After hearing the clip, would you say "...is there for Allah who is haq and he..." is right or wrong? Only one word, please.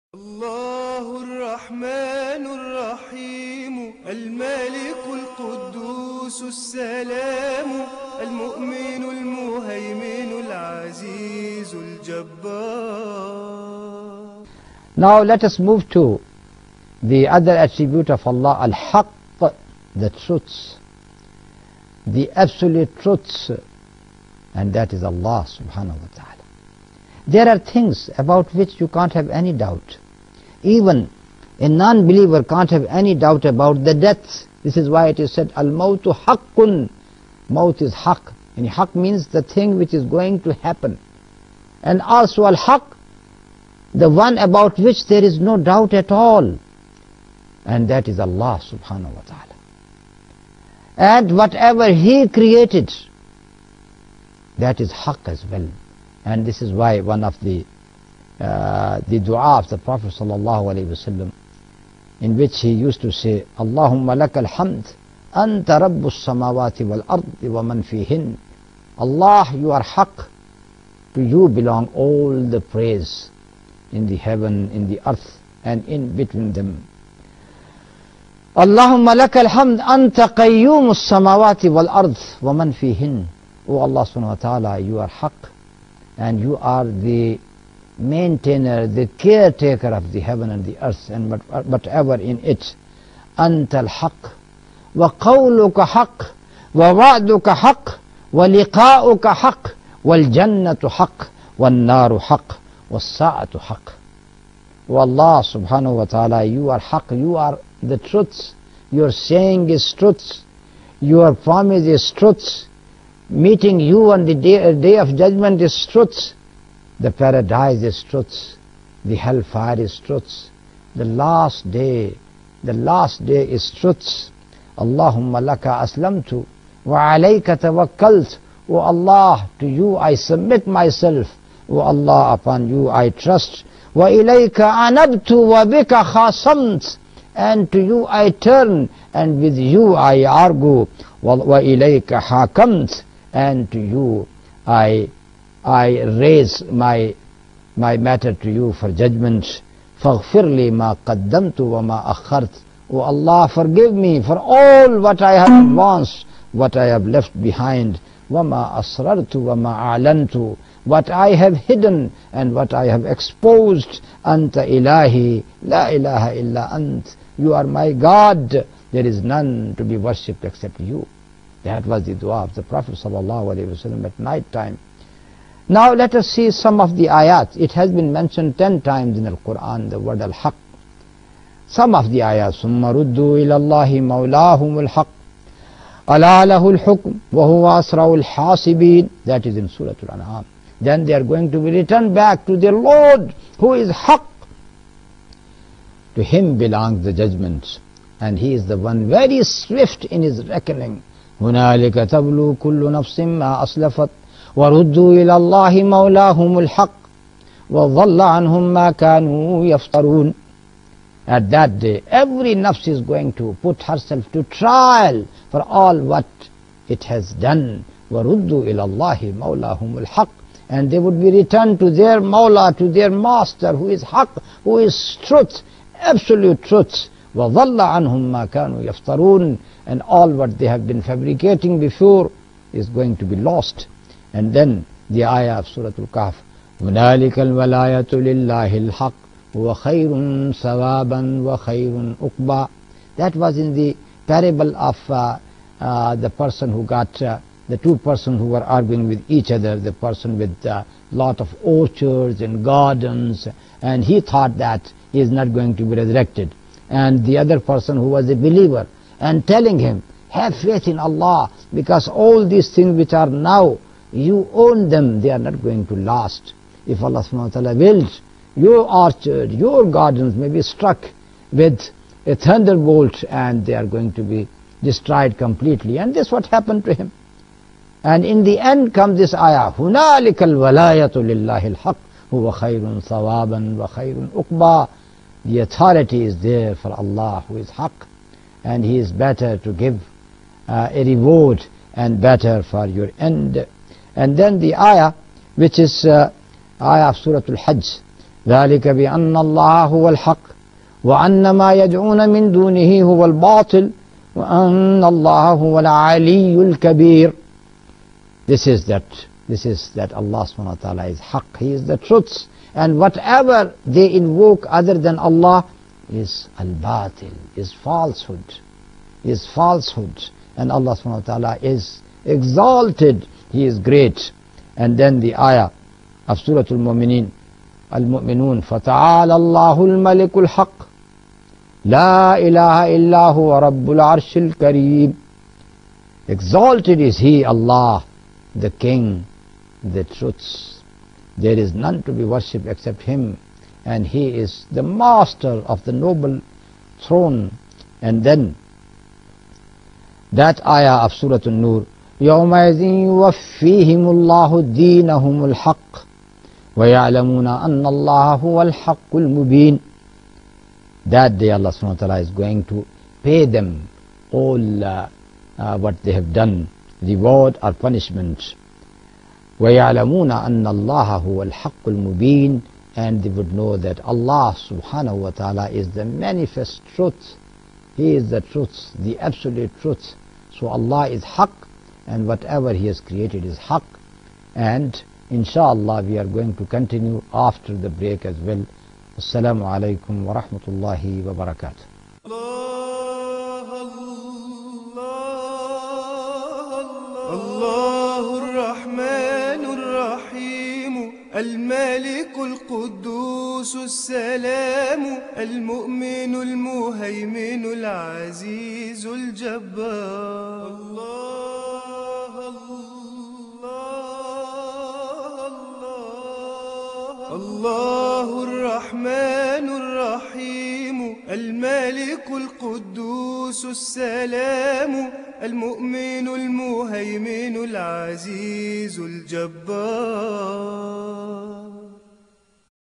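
right.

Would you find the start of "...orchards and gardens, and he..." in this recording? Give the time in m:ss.
4:11.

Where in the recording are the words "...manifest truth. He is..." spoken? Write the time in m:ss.
6:16.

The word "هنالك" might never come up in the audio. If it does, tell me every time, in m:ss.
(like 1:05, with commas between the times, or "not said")
3:21, 3:56, 4:39.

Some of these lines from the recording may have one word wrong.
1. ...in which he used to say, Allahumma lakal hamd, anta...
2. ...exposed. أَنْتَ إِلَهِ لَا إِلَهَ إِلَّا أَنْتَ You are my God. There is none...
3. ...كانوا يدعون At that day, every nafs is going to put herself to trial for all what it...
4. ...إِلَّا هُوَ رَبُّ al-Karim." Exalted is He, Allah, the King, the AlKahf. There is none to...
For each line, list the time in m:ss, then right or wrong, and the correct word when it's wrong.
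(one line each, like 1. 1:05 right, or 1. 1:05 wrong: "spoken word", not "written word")
1. 1:02 right
2. 2:43 right
3. 3:28 wrong: "يفترون", not "يدعون"
4. 5:33 wrong: "Truths", not "AlKahf".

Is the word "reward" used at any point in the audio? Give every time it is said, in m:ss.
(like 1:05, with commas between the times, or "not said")
4:51, 6:07.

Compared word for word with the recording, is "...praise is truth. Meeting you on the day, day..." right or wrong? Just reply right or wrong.
wrong.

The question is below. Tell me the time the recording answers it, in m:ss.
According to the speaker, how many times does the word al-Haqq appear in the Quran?
2:58.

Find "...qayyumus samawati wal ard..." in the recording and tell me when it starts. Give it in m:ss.
1:20.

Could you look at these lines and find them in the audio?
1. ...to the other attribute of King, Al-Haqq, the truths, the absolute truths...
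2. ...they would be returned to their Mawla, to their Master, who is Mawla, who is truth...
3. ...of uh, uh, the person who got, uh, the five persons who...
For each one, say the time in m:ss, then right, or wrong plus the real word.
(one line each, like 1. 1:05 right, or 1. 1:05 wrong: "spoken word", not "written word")
1. 0:15 wrong: "Allah", not "King"
2. 3:40 wrong: "Haqq", not "Mawla"
3. 4:04 wrong: "two", not "five".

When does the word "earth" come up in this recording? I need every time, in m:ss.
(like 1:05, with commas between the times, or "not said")
1:15, 1:30.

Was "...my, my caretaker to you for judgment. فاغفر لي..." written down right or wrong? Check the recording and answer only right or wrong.
wrong.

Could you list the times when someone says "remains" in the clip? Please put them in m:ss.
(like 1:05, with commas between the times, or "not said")
not said.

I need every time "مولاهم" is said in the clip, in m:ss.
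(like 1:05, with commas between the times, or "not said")
3:04, 3:25, 3:39.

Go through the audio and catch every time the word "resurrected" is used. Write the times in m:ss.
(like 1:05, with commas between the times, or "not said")
4:15.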